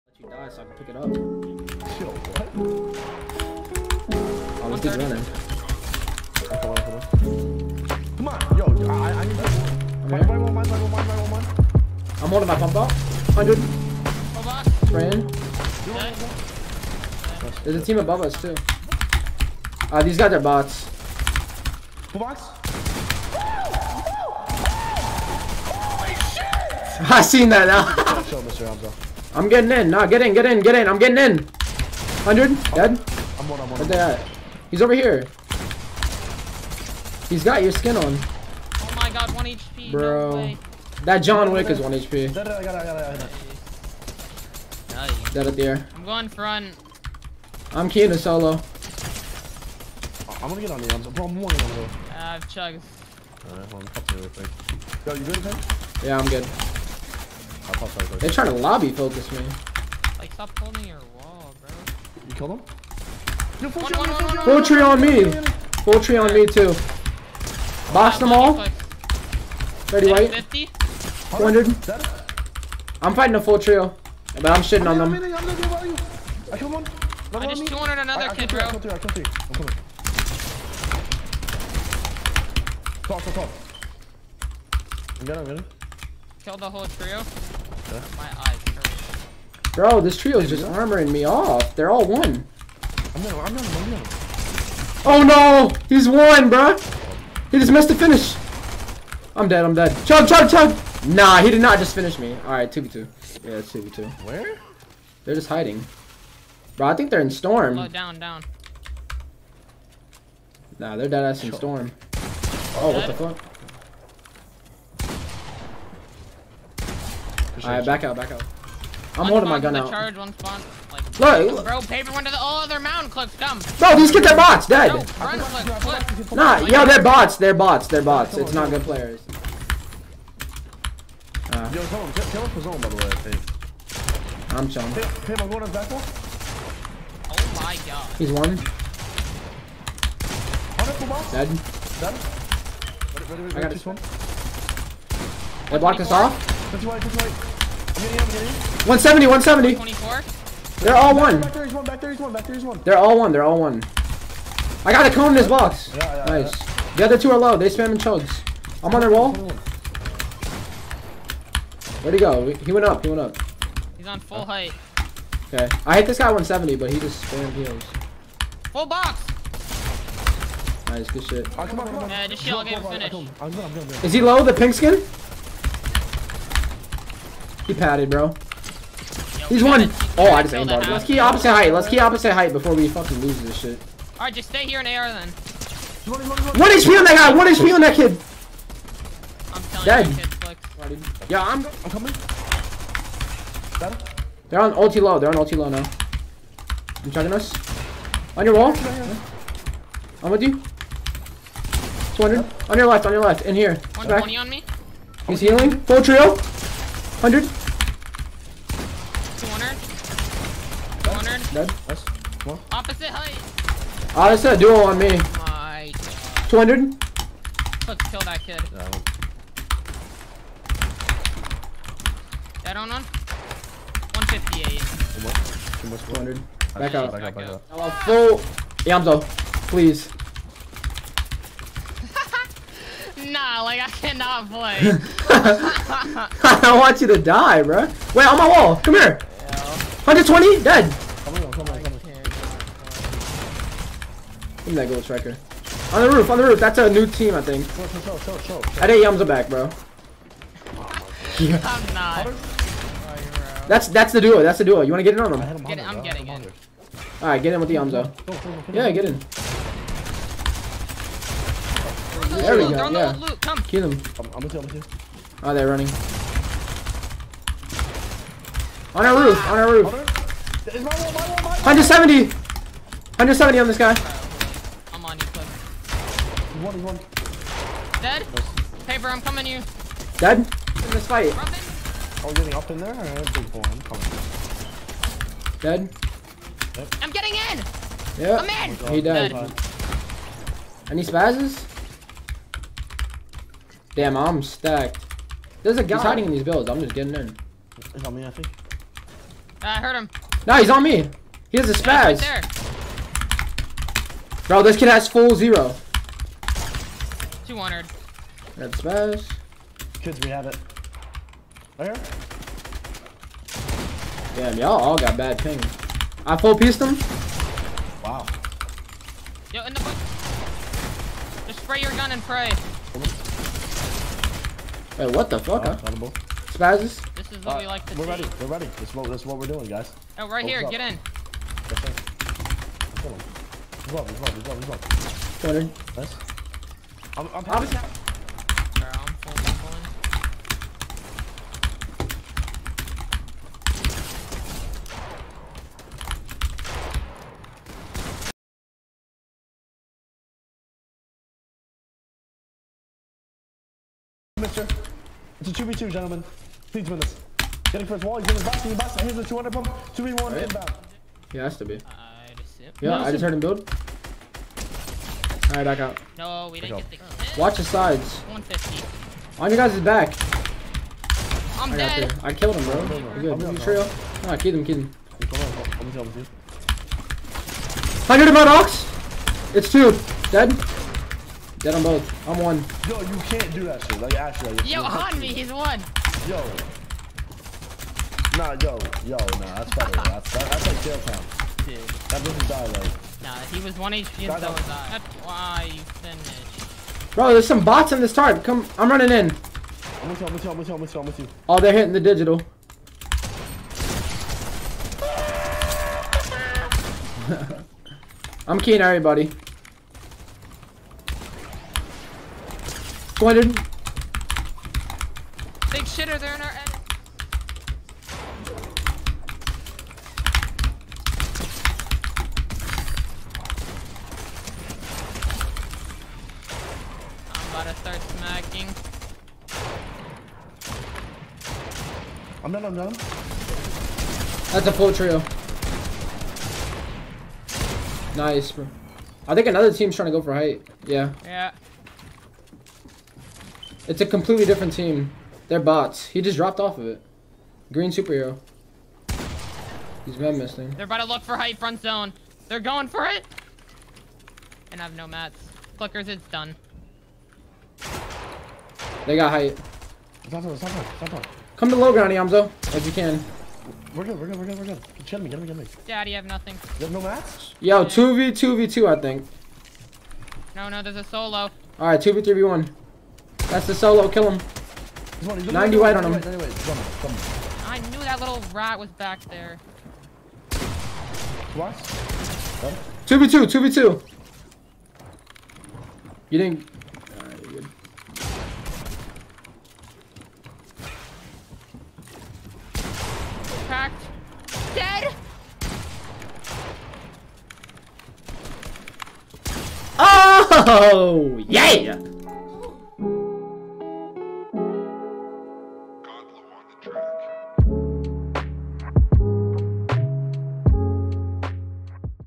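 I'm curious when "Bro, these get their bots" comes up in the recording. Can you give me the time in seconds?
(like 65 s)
123 s.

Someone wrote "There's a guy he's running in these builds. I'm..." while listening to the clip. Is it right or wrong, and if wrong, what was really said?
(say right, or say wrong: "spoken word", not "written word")
wrong: "hiding", not "running".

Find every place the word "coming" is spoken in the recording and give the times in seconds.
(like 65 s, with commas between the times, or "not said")
79 s, 191 s, 279 s, 283 s.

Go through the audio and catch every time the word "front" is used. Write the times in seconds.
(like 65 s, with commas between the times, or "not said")
46 s, 451 s.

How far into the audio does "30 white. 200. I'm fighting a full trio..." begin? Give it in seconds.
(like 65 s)
69 s.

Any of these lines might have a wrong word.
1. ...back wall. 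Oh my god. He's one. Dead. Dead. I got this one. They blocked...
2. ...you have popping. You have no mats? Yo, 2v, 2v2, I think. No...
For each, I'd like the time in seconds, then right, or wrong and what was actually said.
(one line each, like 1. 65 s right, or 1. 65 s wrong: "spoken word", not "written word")
1. 135 s right
2. 466 s wrong: "nothing", not "popping".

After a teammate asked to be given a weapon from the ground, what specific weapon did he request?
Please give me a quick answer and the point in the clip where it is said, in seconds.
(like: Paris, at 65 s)
gold striker, at 244 s.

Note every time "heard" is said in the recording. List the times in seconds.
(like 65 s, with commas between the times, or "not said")
299 s, 363 s.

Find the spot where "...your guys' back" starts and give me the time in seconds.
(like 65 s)
369 s.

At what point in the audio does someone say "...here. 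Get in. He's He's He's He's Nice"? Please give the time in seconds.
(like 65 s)
330 s.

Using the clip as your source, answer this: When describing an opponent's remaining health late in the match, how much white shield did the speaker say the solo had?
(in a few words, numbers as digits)
90.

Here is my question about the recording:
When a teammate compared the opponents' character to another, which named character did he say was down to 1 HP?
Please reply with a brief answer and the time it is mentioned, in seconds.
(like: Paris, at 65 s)
John Wick, at 41 s.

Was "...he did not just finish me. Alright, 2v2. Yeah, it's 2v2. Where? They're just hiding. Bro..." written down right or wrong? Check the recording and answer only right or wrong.
right.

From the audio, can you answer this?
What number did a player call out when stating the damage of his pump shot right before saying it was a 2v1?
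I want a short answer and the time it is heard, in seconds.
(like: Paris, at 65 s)
200, at 359 s.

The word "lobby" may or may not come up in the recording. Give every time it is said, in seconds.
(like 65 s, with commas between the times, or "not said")
58 s.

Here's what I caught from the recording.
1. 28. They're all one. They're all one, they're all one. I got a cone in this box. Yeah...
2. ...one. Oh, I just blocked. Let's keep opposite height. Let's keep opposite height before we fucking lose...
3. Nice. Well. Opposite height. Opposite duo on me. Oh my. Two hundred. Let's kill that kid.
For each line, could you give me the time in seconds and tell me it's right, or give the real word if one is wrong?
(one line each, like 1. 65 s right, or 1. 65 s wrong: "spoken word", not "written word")
1. 149 s wrong: "24", not "28"
2. 179 s wrong: "aimbotted", not "blocked"
3. 211 s right.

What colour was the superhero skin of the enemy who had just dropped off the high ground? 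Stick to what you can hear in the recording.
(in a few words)
Green.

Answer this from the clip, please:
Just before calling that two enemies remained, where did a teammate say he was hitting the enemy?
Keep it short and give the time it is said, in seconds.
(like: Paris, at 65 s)
Ox, at 378 s.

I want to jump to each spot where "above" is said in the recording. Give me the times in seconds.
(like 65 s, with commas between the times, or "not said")
17 s.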